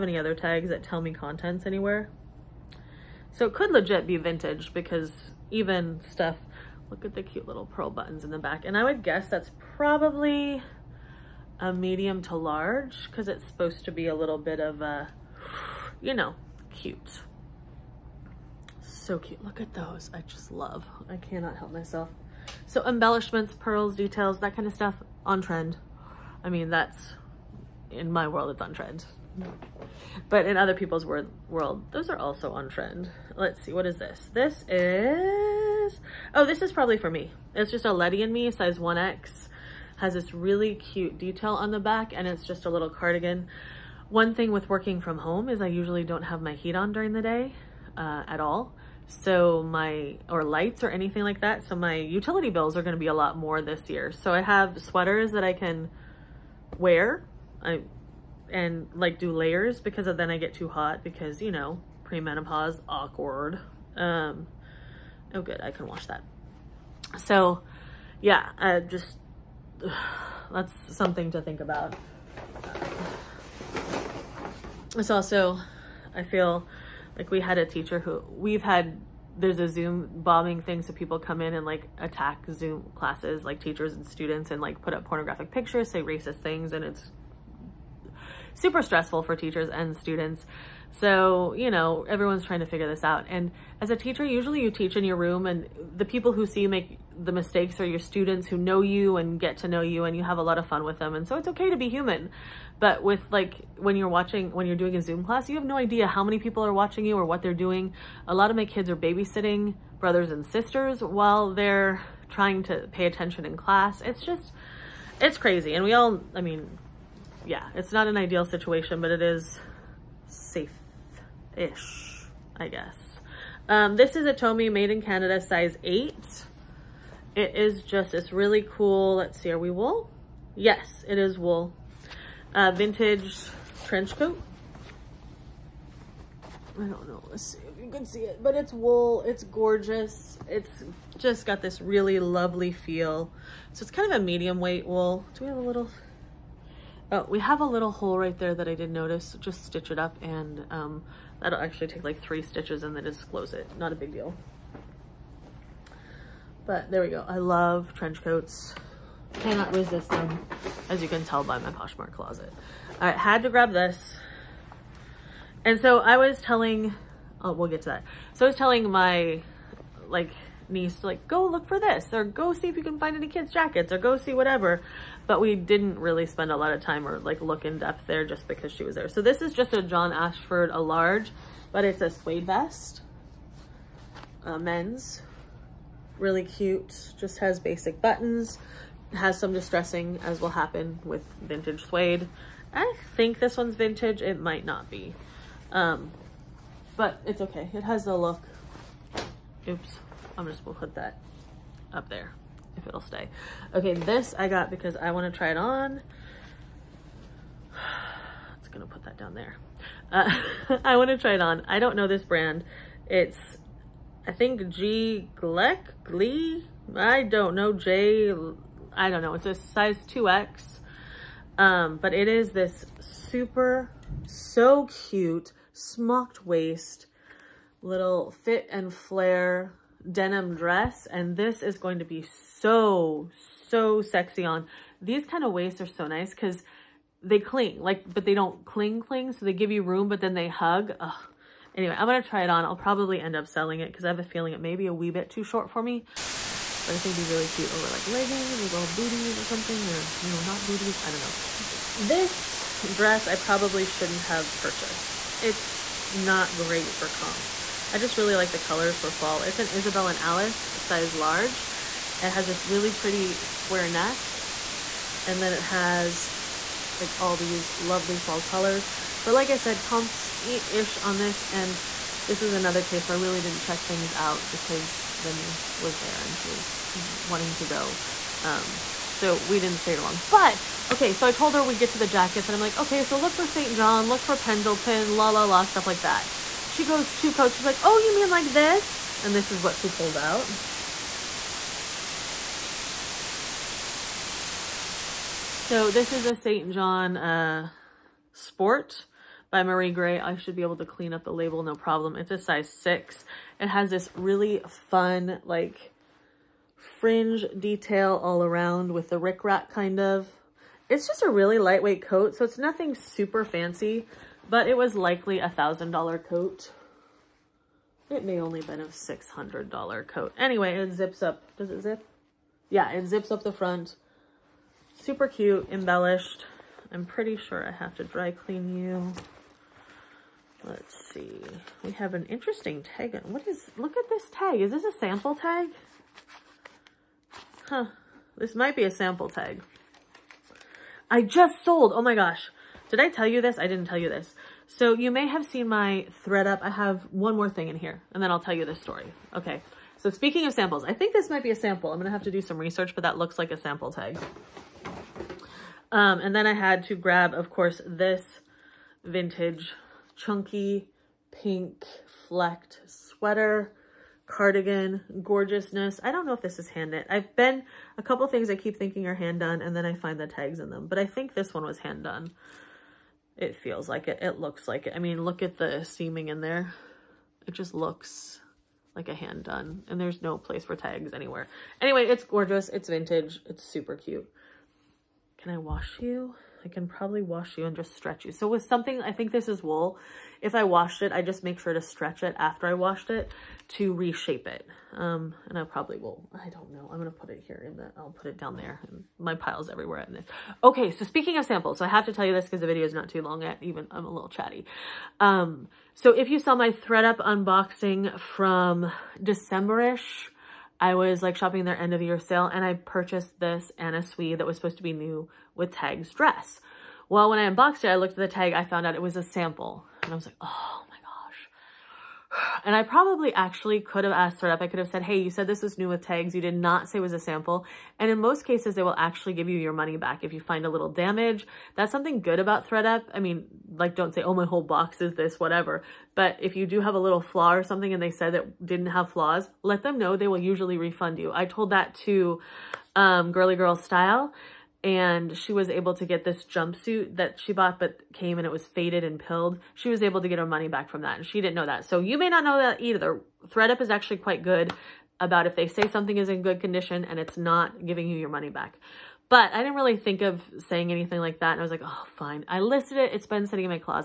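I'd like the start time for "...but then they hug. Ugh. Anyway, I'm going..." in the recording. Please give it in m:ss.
4:00.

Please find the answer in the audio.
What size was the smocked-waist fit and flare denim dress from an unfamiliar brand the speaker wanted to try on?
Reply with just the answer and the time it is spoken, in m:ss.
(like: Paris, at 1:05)
2X, at 3:39.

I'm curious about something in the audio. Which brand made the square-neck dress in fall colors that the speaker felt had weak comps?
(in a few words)
Isabel and Alice.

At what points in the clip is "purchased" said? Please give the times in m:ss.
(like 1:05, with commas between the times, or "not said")
4:14, 6:52.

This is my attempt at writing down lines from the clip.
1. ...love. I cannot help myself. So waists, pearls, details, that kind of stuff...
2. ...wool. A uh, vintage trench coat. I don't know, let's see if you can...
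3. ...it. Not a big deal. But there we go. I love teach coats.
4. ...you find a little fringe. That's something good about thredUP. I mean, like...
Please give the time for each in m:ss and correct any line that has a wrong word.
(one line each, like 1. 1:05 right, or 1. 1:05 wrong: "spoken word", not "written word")
1. 0:20 wrong: "embellishments", not "waists"
2. 2:11 right
3. 2:33 wrong: "trench", not "teach"
4. 7:10 wrong: "damage", not "fringe".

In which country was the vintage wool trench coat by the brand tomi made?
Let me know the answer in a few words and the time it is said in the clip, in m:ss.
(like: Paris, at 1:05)
Canada, at 2:05.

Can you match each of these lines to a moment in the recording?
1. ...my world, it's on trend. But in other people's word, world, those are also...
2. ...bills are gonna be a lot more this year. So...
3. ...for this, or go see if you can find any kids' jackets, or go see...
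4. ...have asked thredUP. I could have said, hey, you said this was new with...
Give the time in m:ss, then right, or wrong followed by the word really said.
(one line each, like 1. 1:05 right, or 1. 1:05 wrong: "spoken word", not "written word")
1. 0:28 right
2. 0:52 right
3. 2:51 right
4. 7:04 right.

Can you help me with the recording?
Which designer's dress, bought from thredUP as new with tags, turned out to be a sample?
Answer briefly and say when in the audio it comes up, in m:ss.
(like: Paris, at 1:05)
Anna Sui, at 6:53.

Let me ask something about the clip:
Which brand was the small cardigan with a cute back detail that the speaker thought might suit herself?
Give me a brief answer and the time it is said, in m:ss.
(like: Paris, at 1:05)
Letty and Me, at 0:37.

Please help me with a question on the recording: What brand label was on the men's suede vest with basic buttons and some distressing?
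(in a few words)
John Ashford.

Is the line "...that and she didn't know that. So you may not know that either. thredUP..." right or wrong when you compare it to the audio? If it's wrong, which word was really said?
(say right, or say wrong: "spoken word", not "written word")
right.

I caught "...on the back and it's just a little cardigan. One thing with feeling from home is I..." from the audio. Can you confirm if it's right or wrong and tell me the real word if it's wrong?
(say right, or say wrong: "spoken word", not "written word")
wrong: "working", not "feeling".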